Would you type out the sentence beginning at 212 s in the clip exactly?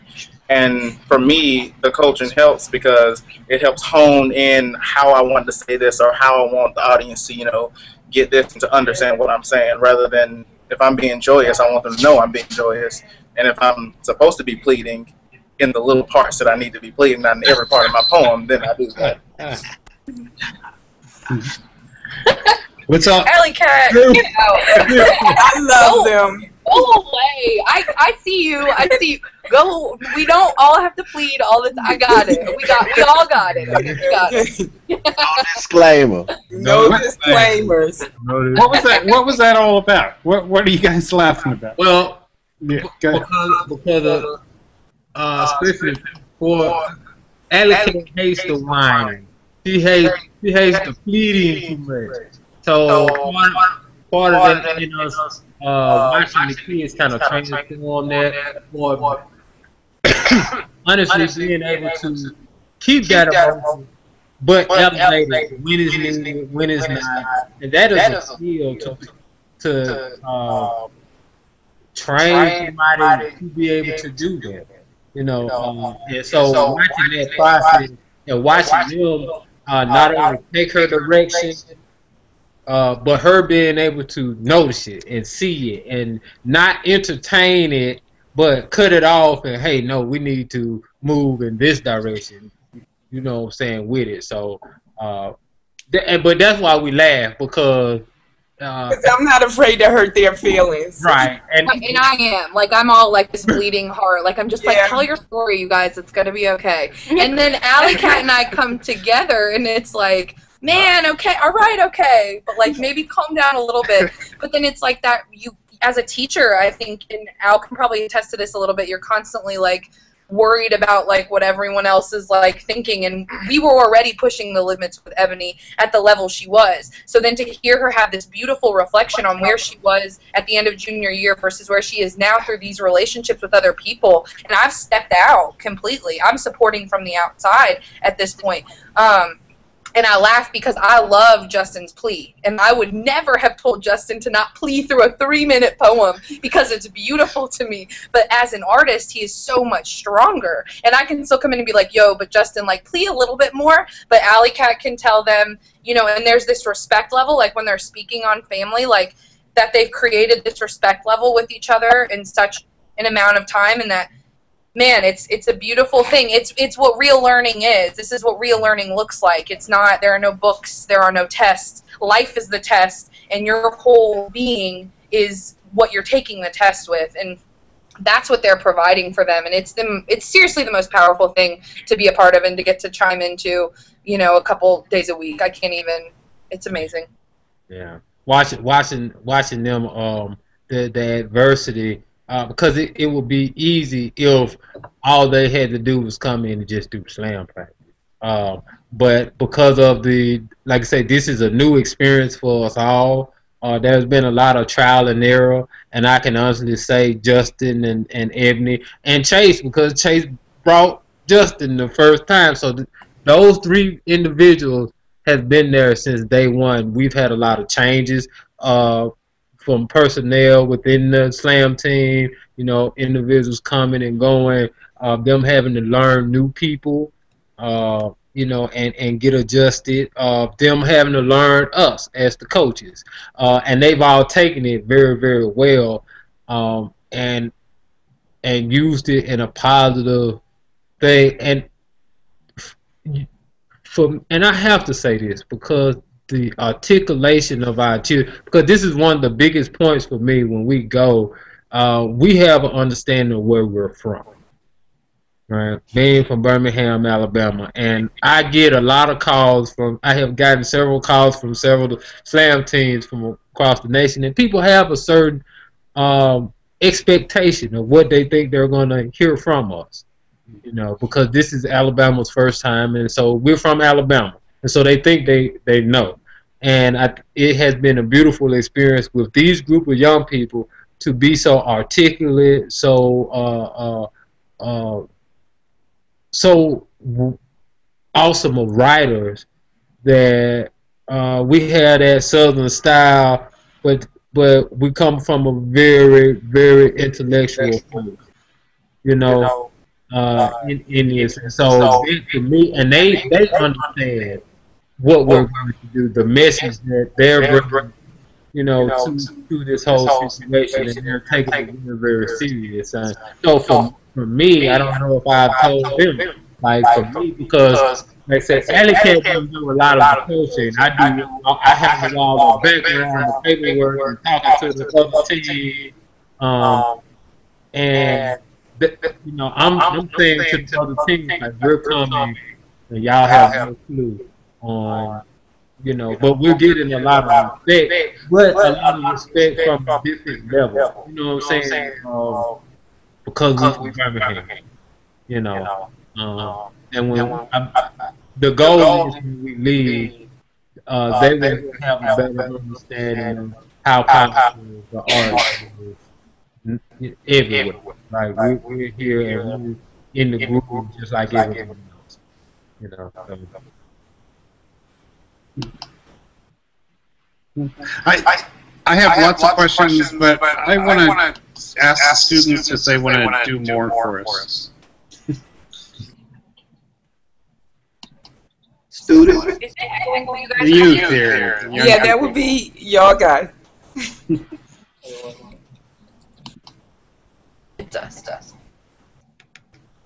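So th those three individuals have been there since day one.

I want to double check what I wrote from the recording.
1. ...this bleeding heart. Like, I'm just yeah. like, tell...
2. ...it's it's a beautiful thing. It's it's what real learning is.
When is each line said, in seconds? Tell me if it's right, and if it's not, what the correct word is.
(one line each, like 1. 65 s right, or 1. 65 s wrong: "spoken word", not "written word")
1. 103 s right
2. 165 s right.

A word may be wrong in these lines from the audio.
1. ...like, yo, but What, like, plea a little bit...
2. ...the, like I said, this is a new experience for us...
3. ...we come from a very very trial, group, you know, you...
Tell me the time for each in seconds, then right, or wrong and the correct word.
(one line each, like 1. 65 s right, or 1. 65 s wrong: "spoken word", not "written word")
1. 151 s wrong: "Justin", not "What"
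2. 200 s right
3. 294 s wrong: "intellectual", not "trial".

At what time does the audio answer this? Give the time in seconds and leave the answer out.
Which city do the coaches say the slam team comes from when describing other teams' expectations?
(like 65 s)
256 s.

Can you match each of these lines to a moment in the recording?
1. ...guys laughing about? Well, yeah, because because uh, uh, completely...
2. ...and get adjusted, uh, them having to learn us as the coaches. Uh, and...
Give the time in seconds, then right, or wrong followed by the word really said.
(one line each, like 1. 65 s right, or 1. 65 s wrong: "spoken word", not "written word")
1. 40 s wrong: "especially", not "completely"
2. 228 s right.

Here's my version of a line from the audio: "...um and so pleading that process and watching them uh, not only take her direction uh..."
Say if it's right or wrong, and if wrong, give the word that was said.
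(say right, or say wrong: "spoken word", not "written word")
wrong: "watching", not "pleading".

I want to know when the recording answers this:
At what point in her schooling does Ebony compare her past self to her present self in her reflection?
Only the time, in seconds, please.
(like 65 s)
130 s.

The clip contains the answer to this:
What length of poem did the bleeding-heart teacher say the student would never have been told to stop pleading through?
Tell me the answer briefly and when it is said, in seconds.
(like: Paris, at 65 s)
3 minutes, at 145 s.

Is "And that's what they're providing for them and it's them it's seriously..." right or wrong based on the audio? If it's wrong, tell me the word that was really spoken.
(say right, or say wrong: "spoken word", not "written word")
right.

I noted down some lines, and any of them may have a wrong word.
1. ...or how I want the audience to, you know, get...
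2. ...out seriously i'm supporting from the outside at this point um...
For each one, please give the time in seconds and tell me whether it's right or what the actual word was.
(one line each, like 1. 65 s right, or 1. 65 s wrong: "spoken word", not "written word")
1. 5 s right
2. 135 s wrong: "completely", not "seriously".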